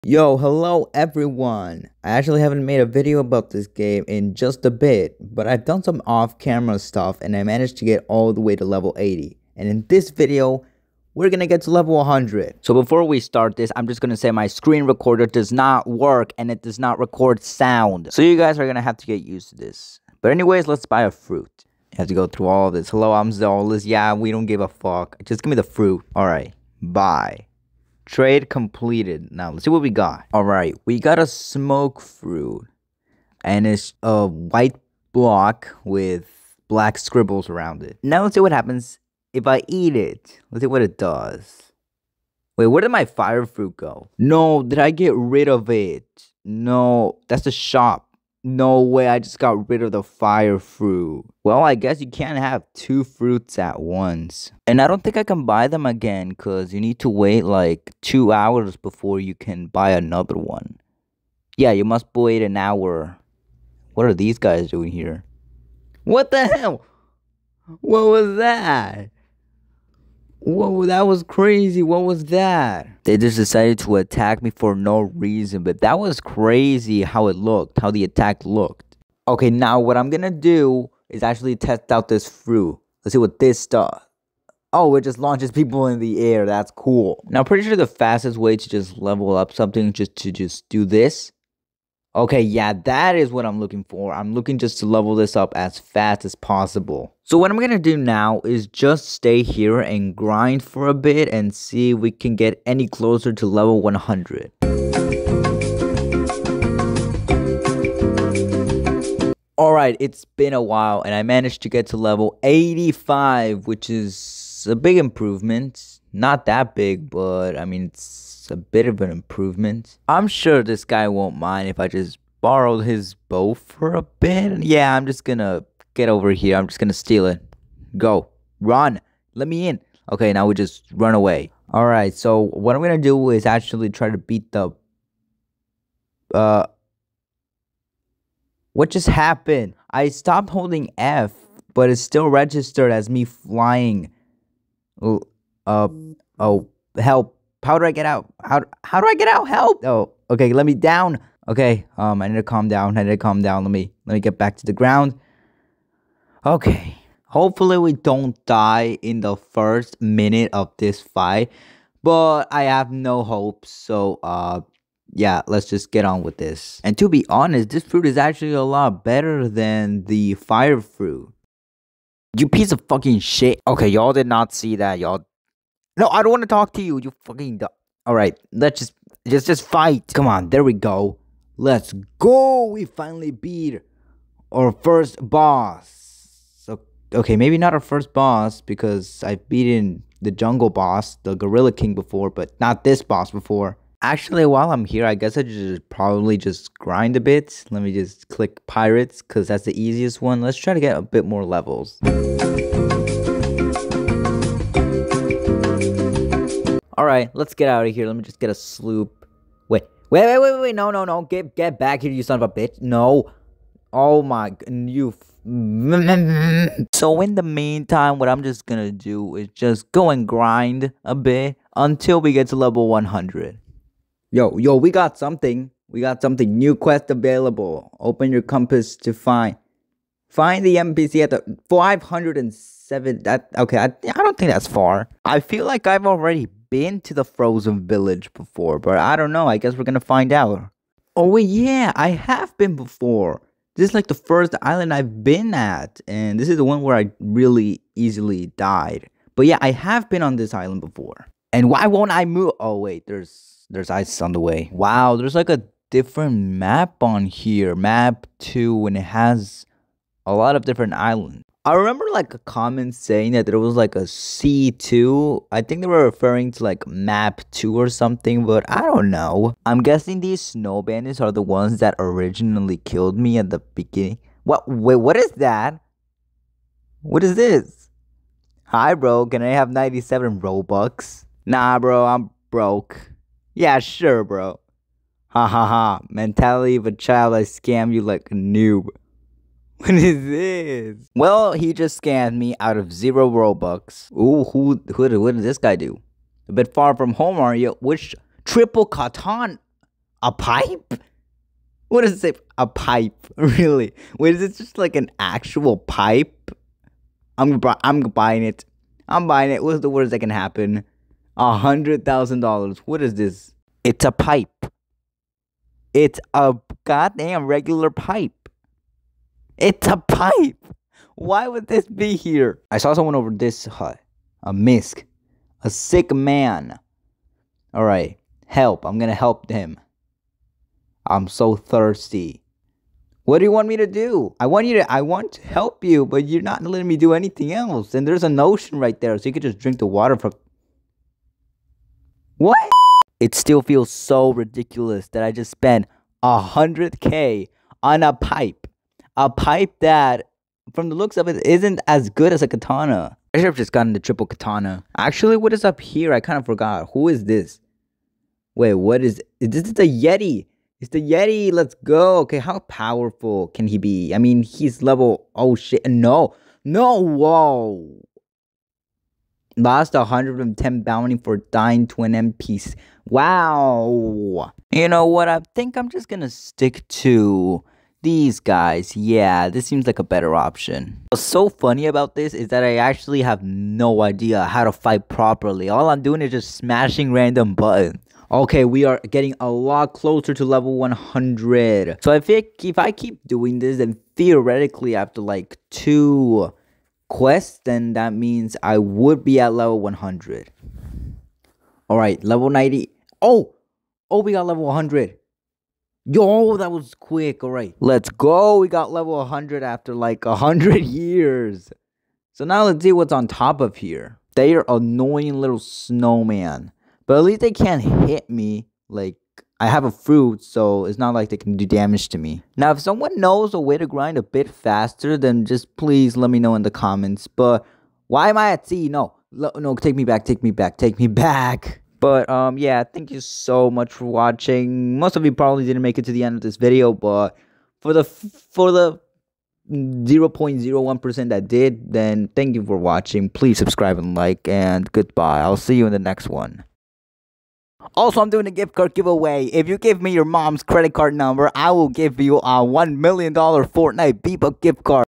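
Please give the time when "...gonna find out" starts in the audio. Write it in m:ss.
3:59.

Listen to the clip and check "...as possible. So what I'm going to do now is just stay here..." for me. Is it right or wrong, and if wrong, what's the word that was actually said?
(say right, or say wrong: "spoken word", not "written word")
right.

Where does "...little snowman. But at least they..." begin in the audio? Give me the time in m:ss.
6:55.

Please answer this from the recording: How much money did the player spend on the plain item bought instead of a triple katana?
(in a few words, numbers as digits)
100,000 dollars.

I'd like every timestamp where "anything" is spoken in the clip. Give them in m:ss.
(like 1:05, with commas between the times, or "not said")
5:37.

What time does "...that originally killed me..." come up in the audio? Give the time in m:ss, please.
4:31.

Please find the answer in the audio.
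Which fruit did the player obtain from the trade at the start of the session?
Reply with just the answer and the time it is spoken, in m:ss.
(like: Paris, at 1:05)
Smoke fruit, at 0:31.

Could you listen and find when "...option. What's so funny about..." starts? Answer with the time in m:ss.
6:20.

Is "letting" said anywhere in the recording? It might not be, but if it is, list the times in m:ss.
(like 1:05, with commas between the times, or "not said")
5:36.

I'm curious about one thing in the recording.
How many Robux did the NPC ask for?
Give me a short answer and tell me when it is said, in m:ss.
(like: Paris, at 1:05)
97, at 4:39.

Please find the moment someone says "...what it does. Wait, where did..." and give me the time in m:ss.
0:40.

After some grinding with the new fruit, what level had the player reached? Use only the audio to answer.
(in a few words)
85.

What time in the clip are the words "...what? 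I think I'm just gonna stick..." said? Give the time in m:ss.
6:15.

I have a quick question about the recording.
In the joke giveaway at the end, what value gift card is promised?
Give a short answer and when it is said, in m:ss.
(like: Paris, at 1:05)
$1 million, at 7:32.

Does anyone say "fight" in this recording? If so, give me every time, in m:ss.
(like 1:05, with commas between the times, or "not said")
2:40, 2:59, 6:24.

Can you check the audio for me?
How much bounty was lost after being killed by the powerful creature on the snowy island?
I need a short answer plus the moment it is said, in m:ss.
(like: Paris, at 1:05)
110, at 6:09.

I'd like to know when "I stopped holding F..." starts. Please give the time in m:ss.
2:19.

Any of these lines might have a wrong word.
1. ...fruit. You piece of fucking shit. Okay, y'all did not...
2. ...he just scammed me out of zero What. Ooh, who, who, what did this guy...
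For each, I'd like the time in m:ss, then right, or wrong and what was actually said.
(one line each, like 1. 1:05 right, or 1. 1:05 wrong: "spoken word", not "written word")
1. 2:50 right
2. 4:51 wrong: "Robux", not "What".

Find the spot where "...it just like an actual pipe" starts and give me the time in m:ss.
5:04.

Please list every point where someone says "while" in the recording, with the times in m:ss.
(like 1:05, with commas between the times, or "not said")
1:50, 3:14.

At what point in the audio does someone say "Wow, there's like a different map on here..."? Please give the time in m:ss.
4:14.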